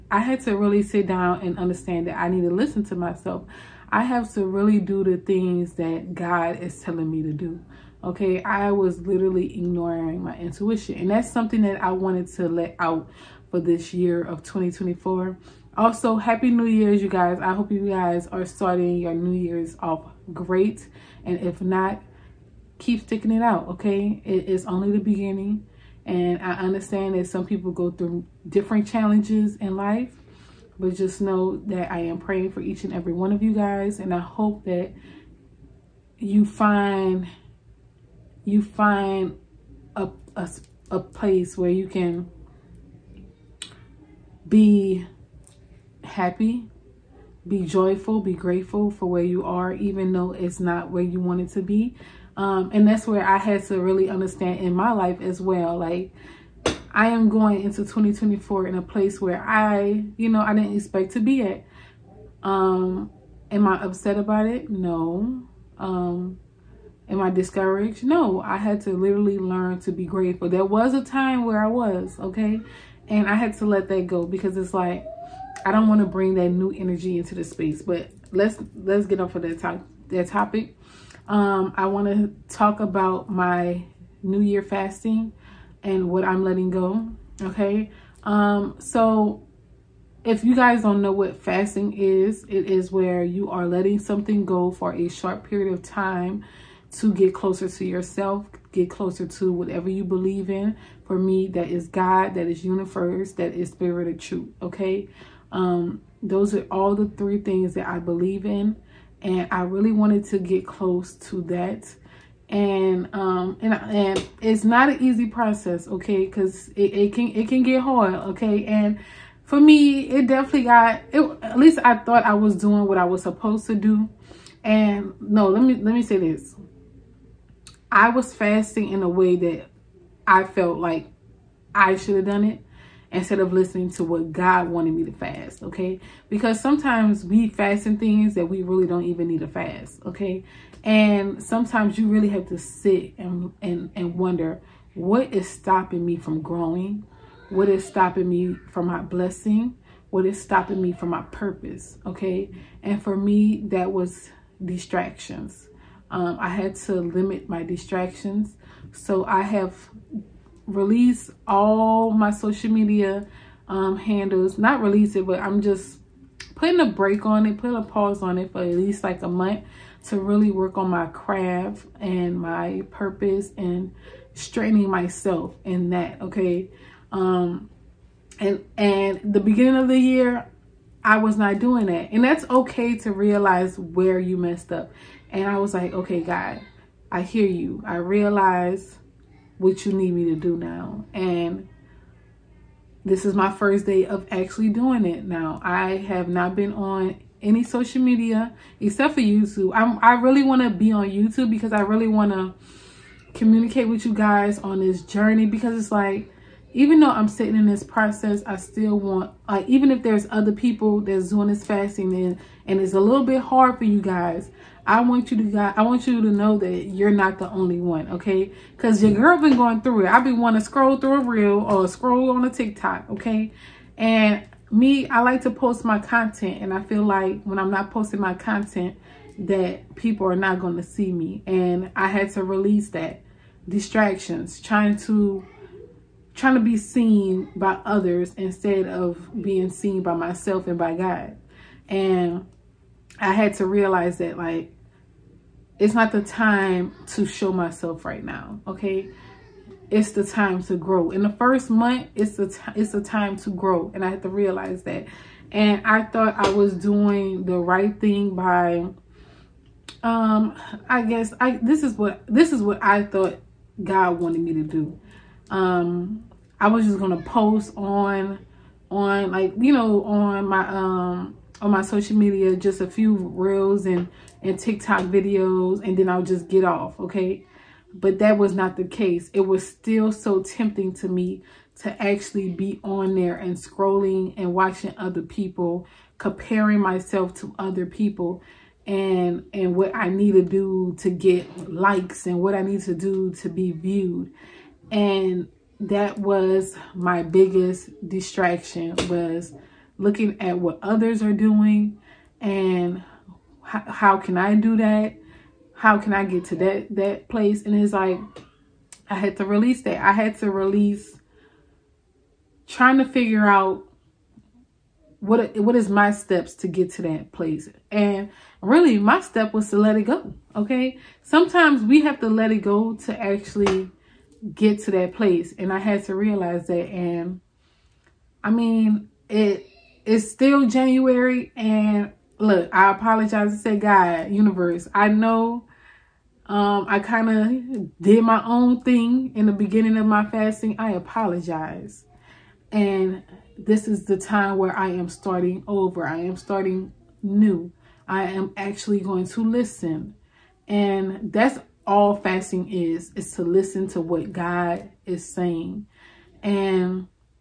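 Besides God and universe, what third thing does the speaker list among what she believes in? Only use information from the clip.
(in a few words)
spirit of truth.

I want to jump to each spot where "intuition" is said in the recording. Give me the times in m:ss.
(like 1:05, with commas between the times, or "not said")
0:10.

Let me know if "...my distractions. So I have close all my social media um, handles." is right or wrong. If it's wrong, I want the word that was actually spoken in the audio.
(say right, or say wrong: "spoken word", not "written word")
wrong: "release", not "close".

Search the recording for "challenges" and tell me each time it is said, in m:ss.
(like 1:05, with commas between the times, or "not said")
0:28.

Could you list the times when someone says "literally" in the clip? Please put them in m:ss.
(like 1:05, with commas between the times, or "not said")
0:09, 1:08.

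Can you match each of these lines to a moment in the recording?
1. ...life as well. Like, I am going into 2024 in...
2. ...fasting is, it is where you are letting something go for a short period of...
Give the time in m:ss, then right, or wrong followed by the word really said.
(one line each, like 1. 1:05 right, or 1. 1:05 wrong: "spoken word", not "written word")
1. 0:54 right
2. 1:31 right.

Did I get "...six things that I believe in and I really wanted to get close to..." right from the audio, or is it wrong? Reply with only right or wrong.
wrong.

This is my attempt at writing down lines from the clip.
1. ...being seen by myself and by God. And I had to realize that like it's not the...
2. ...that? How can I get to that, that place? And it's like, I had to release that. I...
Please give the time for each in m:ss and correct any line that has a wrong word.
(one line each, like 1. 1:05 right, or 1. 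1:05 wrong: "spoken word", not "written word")
1. 3:59 right
2. 5:04 right.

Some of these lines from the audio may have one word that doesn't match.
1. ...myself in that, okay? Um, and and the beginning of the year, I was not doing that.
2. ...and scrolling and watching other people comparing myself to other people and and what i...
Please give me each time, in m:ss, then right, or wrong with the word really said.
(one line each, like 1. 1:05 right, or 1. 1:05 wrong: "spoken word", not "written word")
1. 2:54 right
2. 4:43 right.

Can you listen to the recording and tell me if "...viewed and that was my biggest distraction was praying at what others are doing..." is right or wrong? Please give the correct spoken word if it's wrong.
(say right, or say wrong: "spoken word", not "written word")
wrong: "looking", not "praying".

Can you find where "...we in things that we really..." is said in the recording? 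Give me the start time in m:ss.
2:17.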